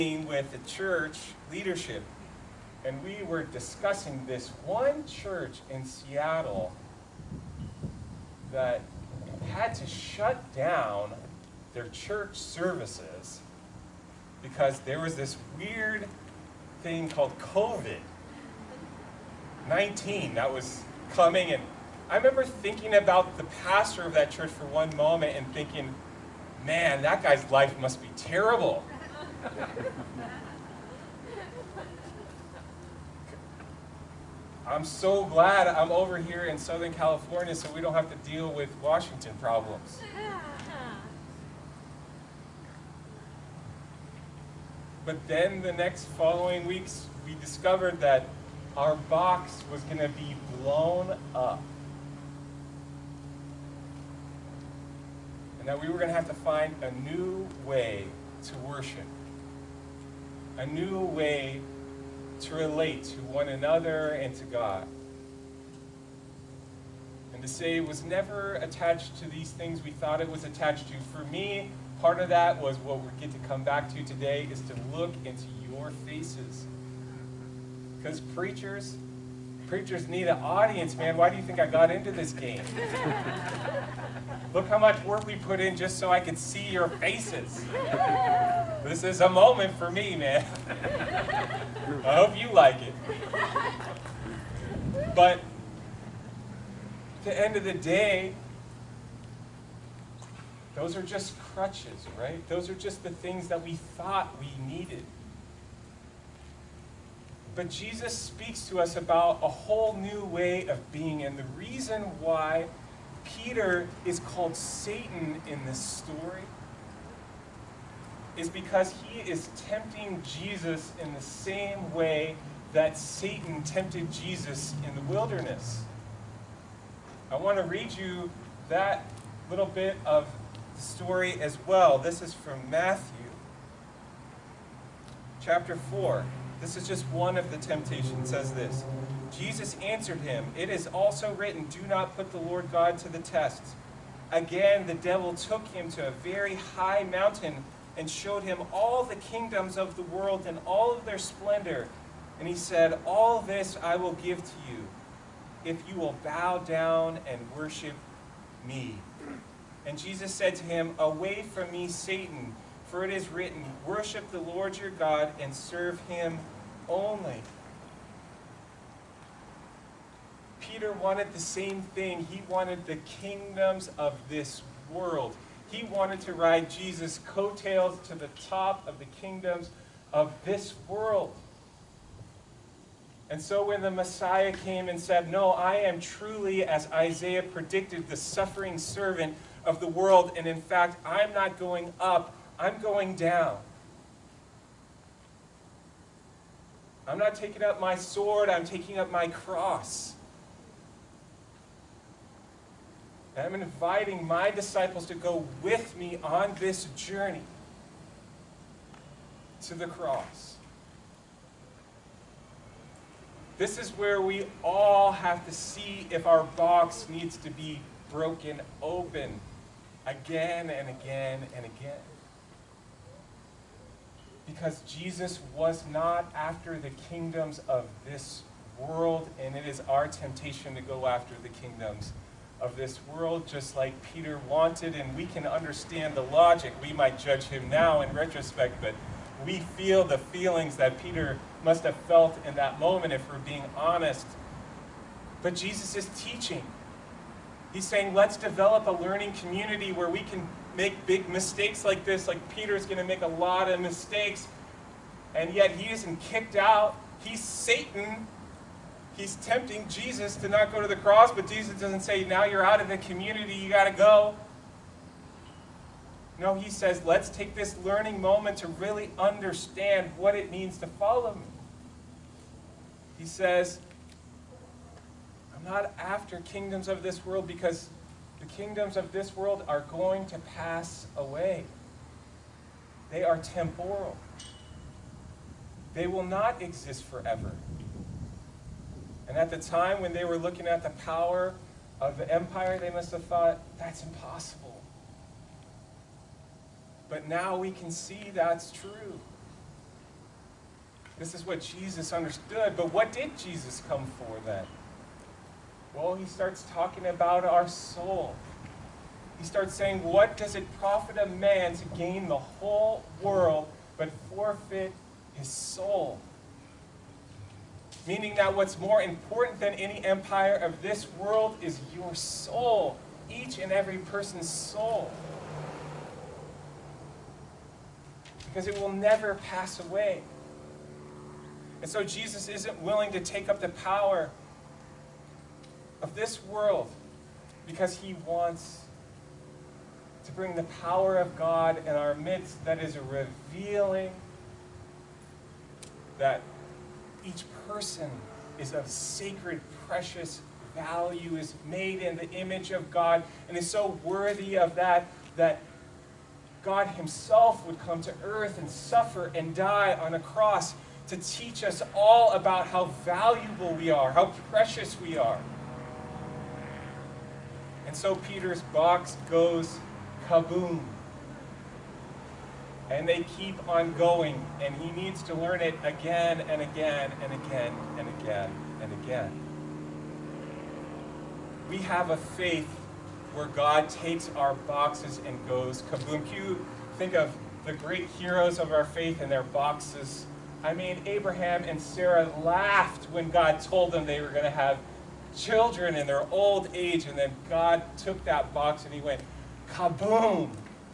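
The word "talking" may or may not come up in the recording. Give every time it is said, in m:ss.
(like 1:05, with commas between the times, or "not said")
5:06.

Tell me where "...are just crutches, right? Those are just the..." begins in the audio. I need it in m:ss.
1:40.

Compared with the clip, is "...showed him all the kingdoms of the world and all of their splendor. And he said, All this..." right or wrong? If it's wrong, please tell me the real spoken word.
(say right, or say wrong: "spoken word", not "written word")
right.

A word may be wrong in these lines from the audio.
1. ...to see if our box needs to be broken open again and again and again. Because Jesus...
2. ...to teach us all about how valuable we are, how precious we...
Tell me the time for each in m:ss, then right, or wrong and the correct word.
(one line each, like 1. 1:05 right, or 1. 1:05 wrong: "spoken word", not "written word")
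1. 3:35 right
2. 6:01 right.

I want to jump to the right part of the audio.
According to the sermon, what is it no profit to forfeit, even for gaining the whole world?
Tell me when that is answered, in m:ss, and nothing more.
5:15.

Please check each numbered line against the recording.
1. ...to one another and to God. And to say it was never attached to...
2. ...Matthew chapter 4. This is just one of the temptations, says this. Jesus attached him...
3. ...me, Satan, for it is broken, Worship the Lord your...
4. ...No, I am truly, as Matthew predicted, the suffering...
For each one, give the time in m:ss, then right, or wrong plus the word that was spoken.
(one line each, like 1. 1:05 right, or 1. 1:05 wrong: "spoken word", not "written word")
1. 1:03 right
2. 2:12 wrong: "answered", not "attached"
3. 2:41 wrong: "written", not "broken"
4. 3:05 wrong: "Isaiah", not "Matthew".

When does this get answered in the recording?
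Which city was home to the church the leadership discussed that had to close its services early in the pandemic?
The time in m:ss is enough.
0:05.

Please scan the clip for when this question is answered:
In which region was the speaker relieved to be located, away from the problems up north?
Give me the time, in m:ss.
0:36.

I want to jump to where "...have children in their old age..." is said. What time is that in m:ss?
6:34.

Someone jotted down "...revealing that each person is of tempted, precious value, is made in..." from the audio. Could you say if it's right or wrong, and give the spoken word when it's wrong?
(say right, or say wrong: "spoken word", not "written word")
wrong: "sacred", not "tempted".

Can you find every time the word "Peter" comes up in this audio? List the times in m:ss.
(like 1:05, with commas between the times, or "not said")
1:53, 2:50, 3:54, 4:01, 4:12, 6:08.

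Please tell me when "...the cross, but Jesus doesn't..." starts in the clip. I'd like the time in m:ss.
4:20.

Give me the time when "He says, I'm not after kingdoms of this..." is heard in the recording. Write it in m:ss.
4:33.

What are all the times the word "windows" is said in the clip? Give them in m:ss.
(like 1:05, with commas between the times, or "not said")
not said.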